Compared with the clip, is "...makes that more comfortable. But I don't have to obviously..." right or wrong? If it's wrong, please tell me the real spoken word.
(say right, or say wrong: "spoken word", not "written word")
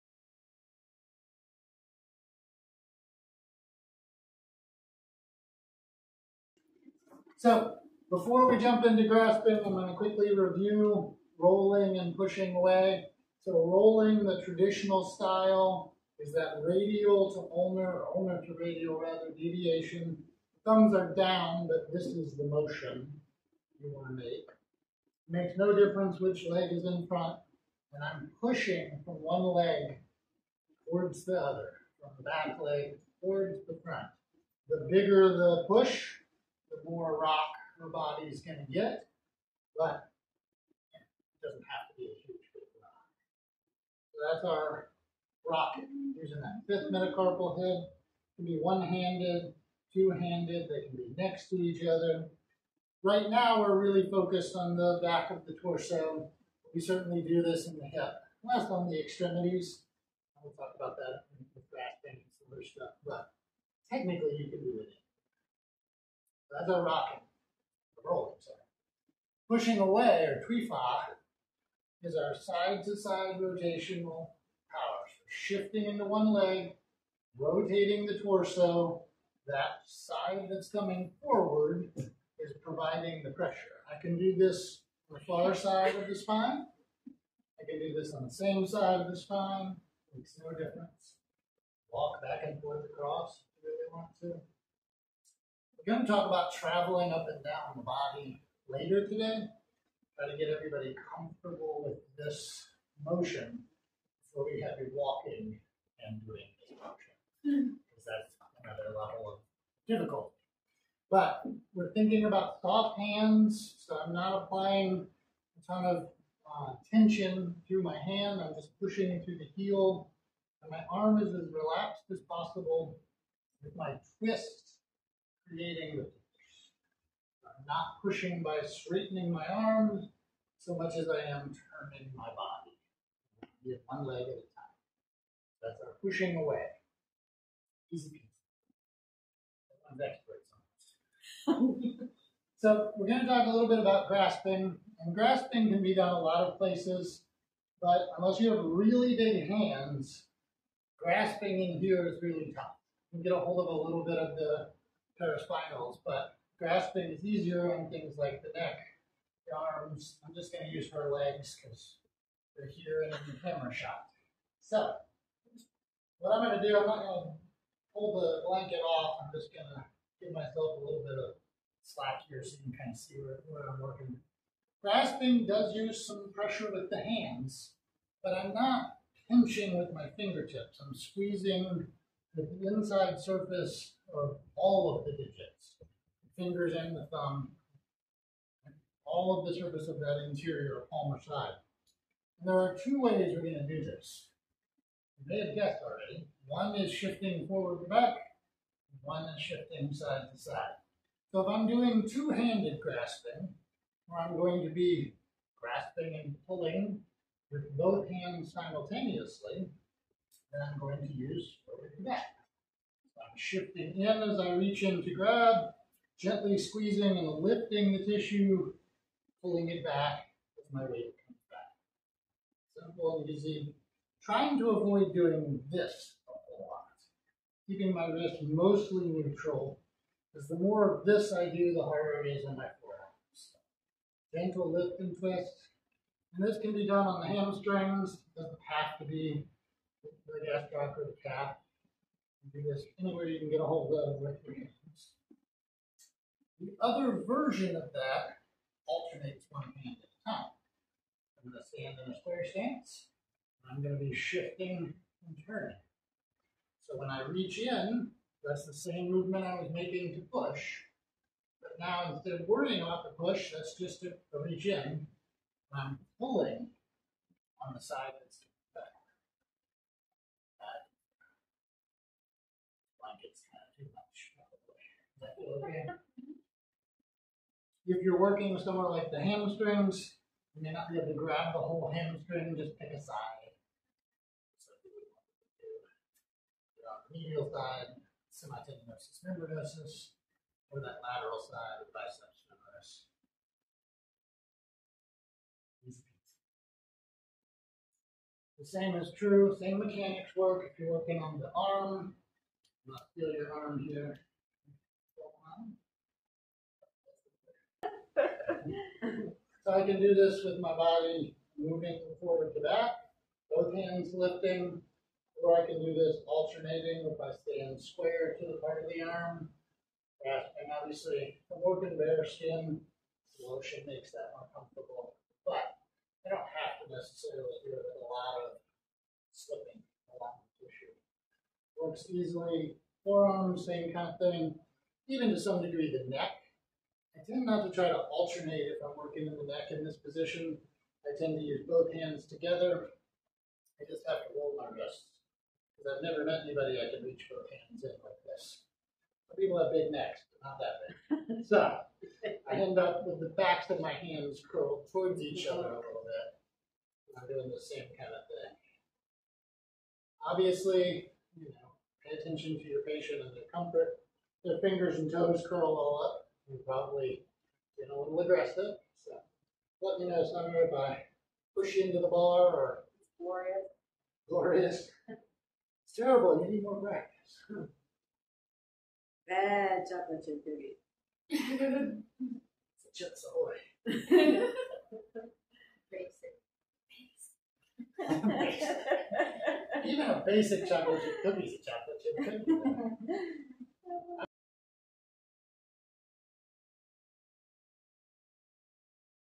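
wrong: "necessarily", not "obviously".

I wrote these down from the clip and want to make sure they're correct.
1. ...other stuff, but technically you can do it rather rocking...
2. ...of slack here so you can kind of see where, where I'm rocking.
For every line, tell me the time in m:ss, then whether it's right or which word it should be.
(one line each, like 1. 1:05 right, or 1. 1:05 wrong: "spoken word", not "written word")
1. 1:02 right
2. 2:51 wrong: "working", not "rocking".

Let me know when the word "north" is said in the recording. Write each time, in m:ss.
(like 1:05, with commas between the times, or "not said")
not said.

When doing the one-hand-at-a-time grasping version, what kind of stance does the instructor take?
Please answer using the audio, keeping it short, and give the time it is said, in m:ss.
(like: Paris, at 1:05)
square stance, at 4:12.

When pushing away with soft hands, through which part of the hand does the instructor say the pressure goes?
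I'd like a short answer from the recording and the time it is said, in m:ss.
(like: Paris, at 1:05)
the heel, at 1:59.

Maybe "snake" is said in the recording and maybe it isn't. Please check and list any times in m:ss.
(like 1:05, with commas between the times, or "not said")
not said.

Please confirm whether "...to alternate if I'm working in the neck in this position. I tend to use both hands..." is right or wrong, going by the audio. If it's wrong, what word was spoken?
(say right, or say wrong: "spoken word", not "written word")
right.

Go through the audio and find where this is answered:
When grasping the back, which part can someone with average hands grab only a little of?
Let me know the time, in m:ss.
2:35.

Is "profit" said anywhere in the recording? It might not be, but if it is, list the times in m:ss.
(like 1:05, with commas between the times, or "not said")
not said.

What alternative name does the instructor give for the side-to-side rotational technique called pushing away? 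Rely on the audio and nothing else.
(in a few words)
tui fa.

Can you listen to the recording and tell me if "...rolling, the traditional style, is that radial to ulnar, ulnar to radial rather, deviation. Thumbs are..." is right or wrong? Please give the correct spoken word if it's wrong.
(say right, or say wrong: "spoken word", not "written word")
right.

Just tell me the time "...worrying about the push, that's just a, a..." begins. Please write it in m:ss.
4:22.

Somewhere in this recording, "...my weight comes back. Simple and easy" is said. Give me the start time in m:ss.
3:40.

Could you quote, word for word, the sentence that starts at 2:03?
With my twist, creating, I'm not pushing by straightening my arms so much as I am turning my body.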